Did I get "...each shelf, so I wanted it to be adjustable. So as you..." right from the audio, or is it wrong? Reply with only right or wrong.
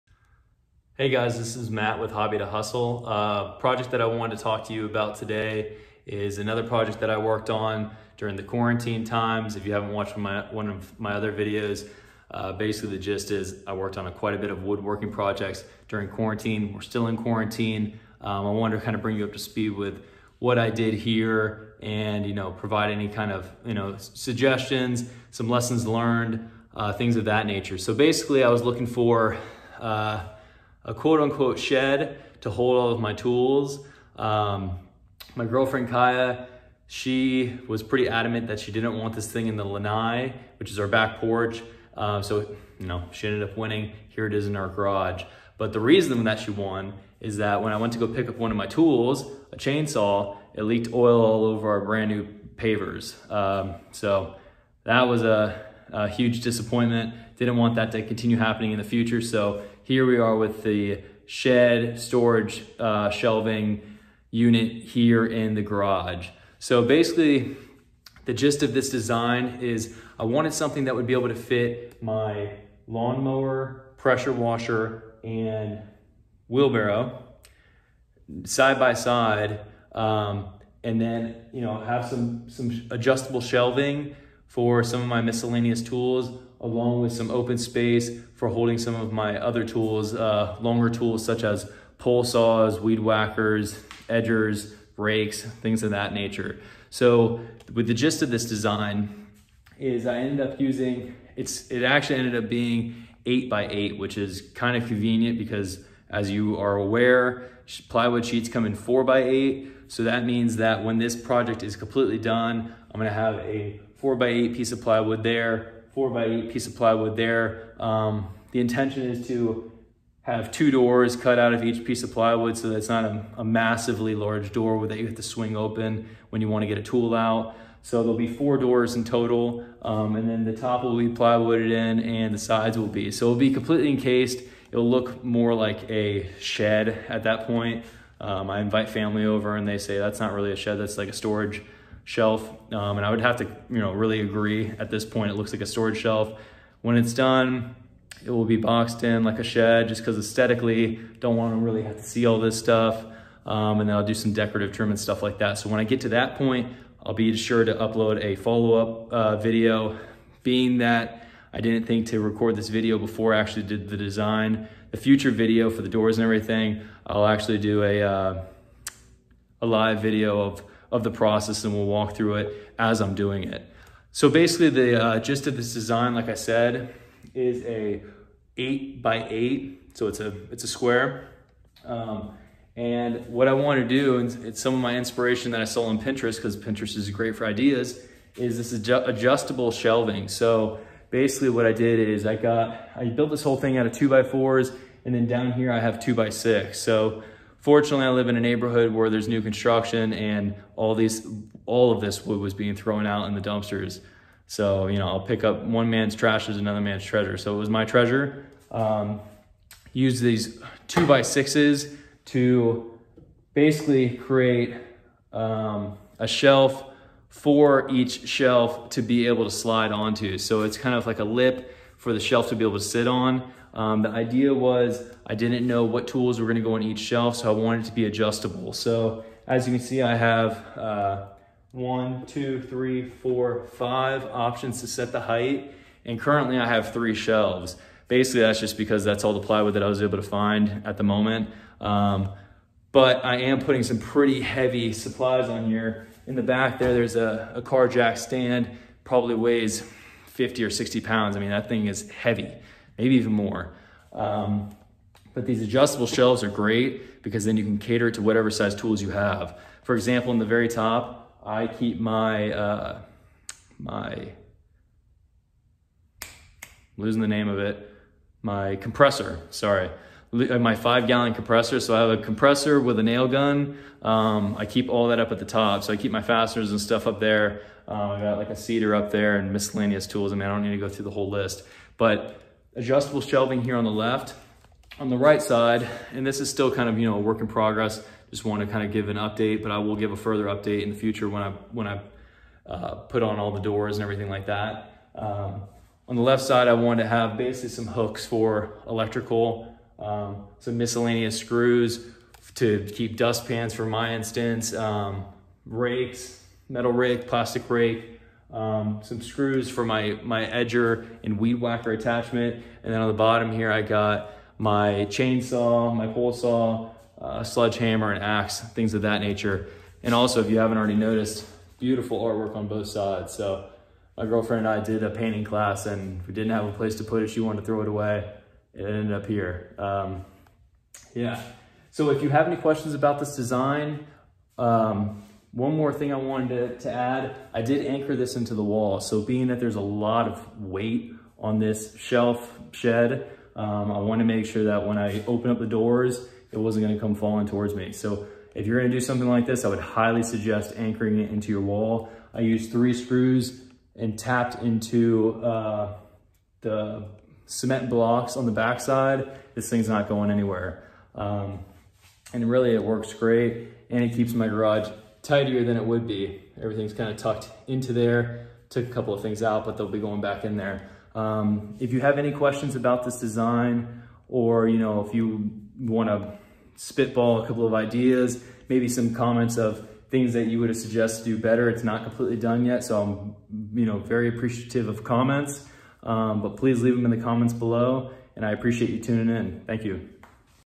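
right.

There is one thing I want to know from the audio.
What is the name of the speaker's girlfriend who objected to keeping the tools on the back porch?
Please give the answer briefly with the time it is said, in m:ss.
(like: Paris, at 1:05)
Kaya, at 0:35.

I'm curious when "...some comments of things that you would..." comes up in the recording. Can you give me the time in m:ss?
6:18.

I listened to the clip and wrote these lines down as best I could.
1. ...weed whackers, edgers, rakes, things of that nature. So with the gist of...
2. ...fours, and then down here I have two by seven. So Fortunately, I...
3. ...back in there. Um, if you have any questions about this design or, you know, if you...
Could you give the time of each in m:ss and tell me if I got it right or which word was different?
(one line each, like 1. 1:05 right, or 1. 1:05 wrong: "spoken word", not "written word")
1. 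1:32 right
2. 3:14 wrong: "six", not "seven"
3. 6:10 right.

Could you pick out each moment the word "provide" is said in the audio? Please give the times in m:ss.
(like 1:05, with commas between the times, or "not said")
0:22.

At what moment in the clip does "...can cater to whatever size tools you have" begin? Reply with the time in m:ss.
4:17.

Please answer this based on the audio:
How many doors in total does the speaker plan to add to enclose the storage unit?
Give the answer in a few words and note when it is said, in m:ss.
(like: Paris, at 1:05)
4, at 2:08.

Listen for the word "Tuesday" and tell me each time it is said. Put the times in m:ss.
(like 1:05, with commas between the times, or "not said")
not said.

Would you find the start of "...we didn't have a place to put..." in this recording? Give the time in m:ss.
5:26.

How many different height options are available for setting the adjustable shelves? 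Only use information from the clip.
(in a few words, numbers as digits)
5.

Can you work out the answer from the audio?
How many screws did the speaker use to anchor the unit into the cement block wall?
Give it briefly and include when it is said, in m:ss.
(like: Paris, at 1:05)
3, at 5:52.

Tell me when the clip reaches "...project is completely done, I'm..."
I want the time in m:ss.
1:51.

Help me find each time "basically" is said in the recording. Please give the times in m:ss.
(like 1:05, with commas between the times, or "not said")
0:12, 0:27, 1:06, 2:54, 3:11, 3:33, 3:58, 4:57.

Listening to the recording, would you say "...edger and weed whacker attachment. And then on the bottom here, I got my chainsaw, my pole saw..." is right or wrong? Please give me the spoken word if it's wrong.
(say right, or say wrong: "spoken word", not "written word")
right.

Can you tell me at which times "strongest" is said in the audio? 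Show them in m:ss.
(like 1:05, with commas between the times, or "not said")
not said.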